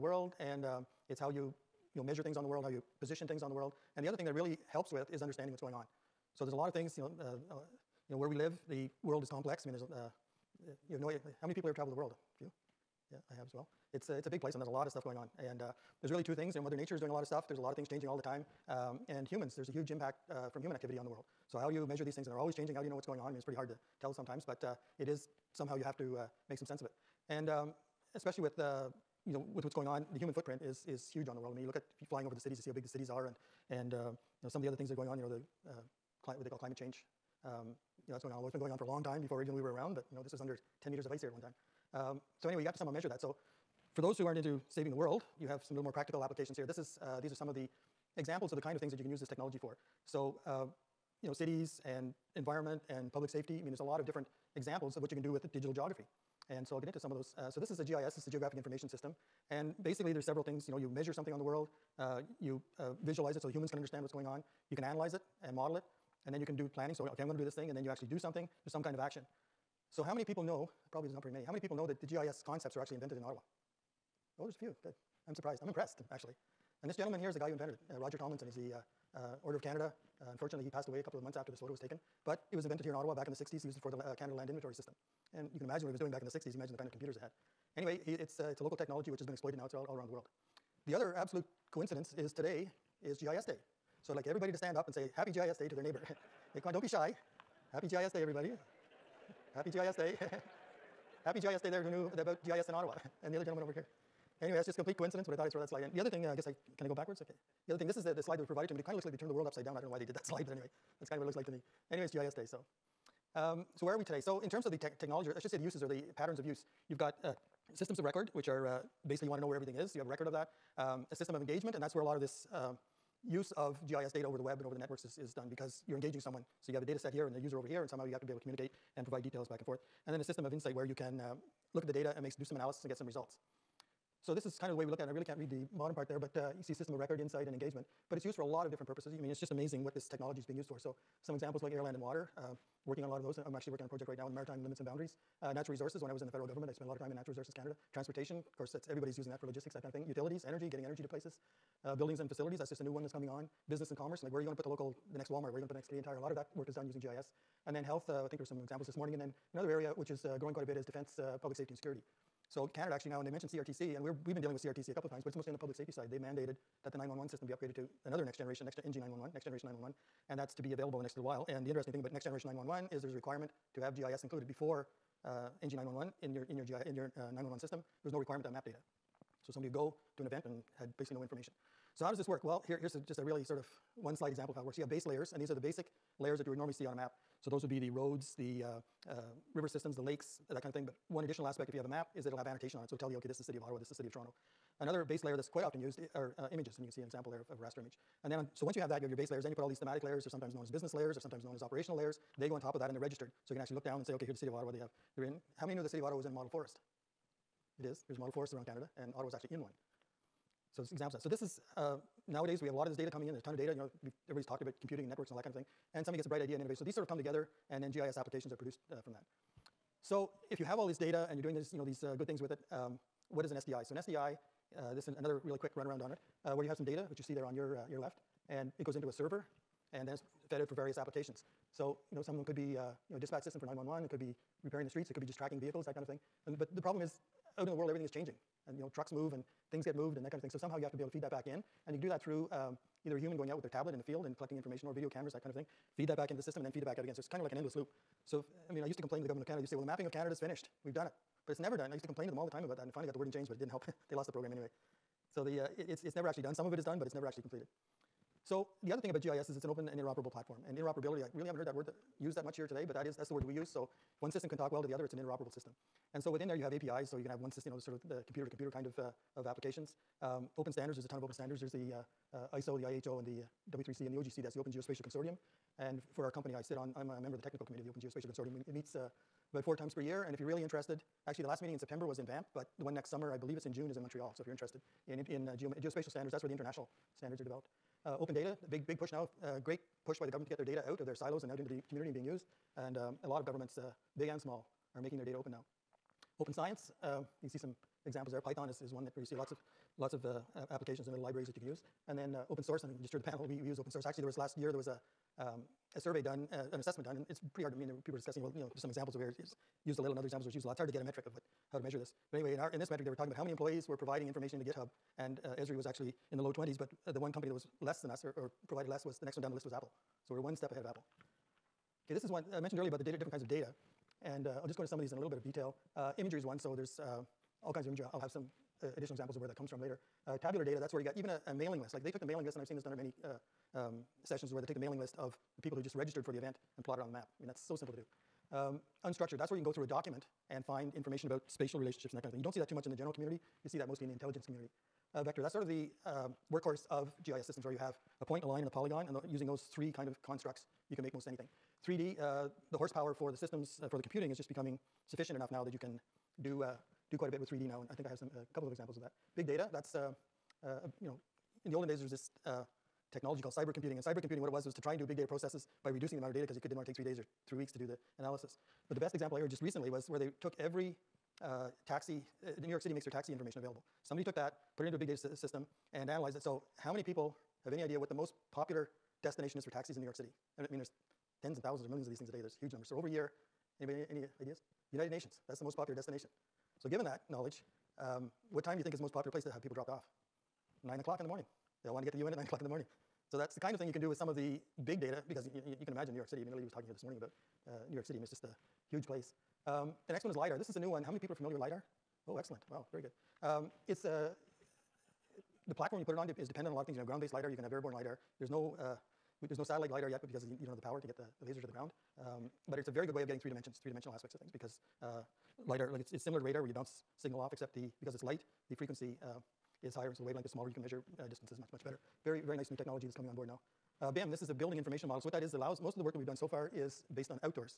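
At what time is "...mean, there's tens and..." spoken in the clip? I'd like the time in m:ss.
6:20.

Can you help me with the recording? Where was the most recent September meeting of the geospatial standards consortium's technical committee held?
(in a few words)
Banff.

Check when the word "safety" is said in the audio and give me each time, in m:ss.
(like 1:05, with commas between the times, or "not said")
0:53, 2:41, 2:45.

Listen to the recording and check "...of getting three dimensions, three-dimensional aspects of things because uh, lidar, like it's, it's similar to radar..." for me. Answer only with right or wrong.
right.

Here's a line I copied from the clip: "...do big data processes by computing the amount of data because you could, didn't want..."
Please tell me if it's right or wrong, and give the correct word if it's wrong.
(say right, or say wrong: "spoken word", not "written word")
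wrong: "reducing", not "computing".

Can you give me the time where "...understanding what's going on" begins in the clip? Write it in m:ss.
0:05.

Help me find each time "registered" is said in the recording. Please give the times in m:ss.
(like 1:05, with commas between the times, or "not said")
3:22, 5:35.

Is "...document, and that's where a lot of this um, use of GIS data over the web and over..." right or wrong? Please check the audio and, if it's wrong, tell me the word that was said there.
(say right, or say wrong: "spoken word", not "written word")
wrong: "engagement", not "document".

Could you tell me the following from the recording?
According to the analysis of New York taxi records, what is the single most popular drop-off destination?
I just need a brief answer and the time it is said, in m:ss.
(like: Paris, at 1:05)
United Nations, at 6:24.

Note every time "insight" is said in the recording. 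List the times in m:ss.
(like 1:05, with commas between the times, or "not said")
2:10, 2:17.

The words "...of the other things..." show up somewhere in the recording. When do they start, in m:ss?
0:34.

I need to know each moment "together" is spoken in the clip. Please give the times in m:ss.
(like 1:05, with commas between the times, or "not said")
3:37.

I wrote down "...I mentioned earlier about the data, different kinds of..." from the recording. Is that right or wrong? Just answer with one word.
right.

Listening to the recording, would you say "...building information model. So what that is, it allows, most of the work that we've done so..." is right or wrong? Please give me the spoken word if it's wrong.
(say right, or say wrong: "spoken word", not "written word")
right.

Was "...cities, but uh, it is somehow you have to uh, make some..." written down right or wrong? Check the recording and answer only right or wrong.
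wrong.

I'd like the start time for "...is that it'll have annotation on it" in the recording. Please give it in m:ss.
3:12.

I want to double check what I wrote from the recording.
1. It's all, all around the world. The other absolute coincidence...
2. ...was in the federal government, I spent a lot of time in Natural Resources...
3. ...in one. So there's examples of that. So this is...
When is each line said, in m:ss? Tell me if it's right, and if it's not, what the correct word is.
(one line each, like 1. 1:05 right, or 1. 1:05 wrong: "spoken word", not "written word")
1. 1:29 right
2. 2:26 right
3. 3:29 right.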